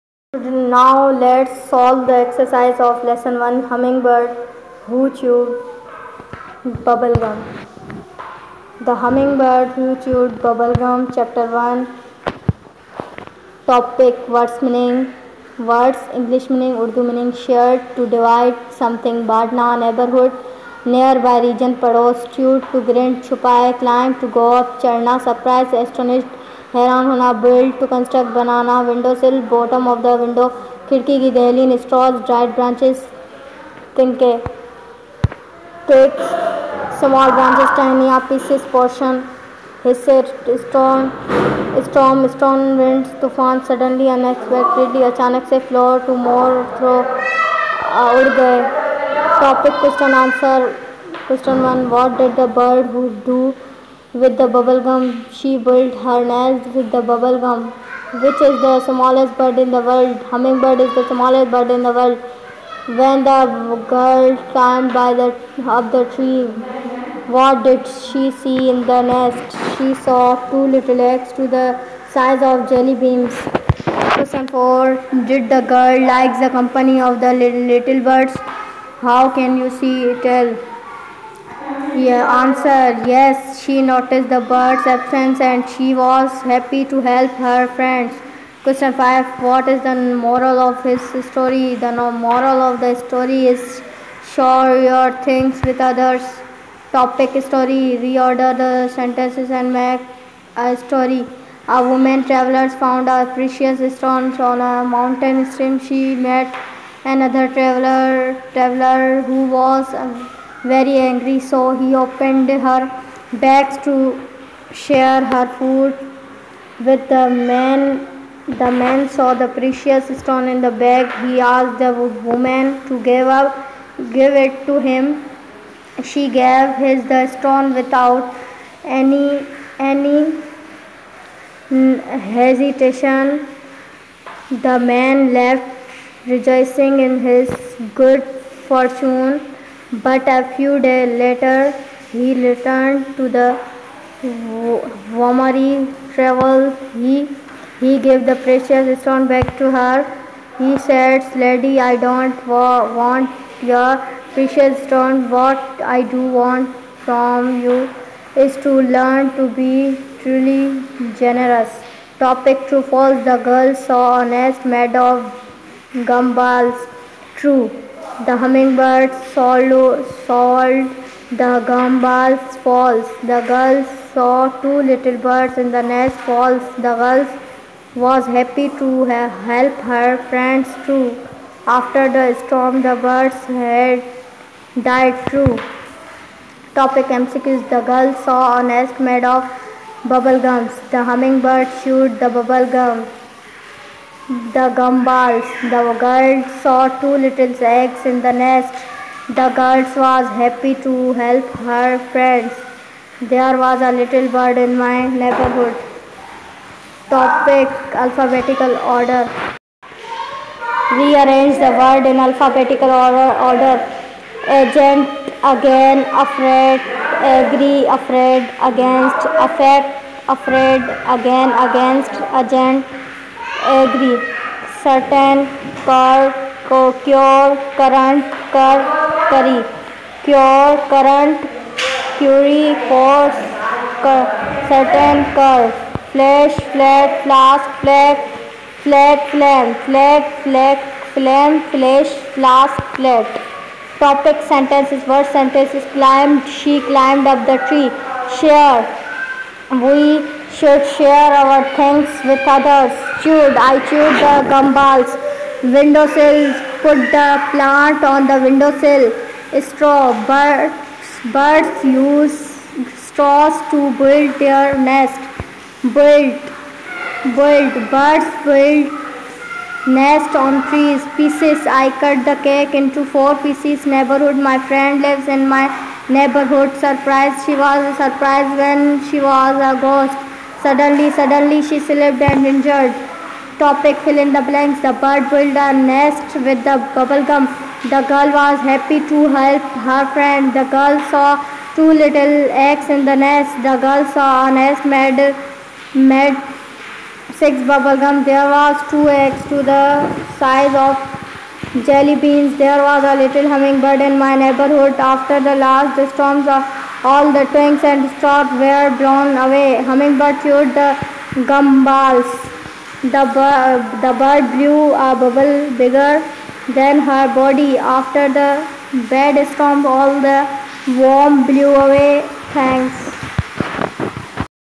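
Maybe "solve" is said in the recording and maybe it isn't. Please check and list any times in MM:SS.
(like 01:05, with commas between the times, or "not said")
00:01.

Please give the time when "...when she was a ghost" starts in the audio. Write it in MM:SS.
04:38.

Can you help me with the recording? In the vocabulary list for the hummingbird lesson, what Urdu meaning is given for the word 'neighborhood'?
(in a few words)
pados.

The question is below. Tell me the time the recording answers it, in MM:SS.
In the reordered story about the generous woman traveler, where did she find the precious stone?
01:44.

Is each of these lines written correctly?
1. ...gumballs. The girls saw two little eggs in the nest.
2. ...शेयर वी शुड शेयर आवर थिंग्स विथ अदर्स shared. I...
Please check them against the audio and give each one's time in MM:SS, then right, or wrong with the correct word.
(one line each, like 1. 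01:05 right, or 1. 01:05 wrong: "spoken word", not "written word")
1. 03:14 right
2. 04:08 wrong: "chewed", not "shared".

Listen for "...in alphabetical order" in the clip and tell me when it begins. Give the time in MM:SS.
03:32.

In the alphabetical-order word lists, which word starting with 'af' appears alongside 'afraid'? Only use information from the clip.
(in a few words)
affect.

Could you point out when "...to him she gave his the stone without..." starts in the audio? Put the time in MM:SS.
02:04.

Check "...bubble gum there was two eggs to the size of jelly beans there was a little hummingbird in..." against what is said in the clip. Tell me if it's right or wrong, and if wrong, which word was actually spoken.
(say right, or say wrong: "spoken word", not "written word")
right.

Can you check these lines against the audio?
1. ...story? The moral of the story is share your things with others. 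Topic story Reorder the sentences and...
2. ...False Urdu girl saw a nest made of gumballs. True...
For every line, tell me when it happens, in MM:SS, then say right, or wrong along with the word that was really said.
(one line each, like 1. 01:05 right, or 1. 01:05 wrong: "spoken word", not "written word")
1. 01:31 right
2. 02:42 wrong: "The", not "Urdu".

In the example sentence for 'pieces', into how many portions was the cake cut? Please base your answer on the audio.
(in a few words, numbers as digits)
4.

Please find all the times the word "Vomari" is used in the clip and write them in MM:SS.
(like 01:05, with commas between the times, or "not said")
02:24.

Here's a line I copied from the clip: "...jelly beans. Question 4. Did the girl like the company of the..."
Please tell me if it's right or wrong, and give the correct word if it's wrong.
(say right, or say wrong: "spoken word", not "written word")
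right.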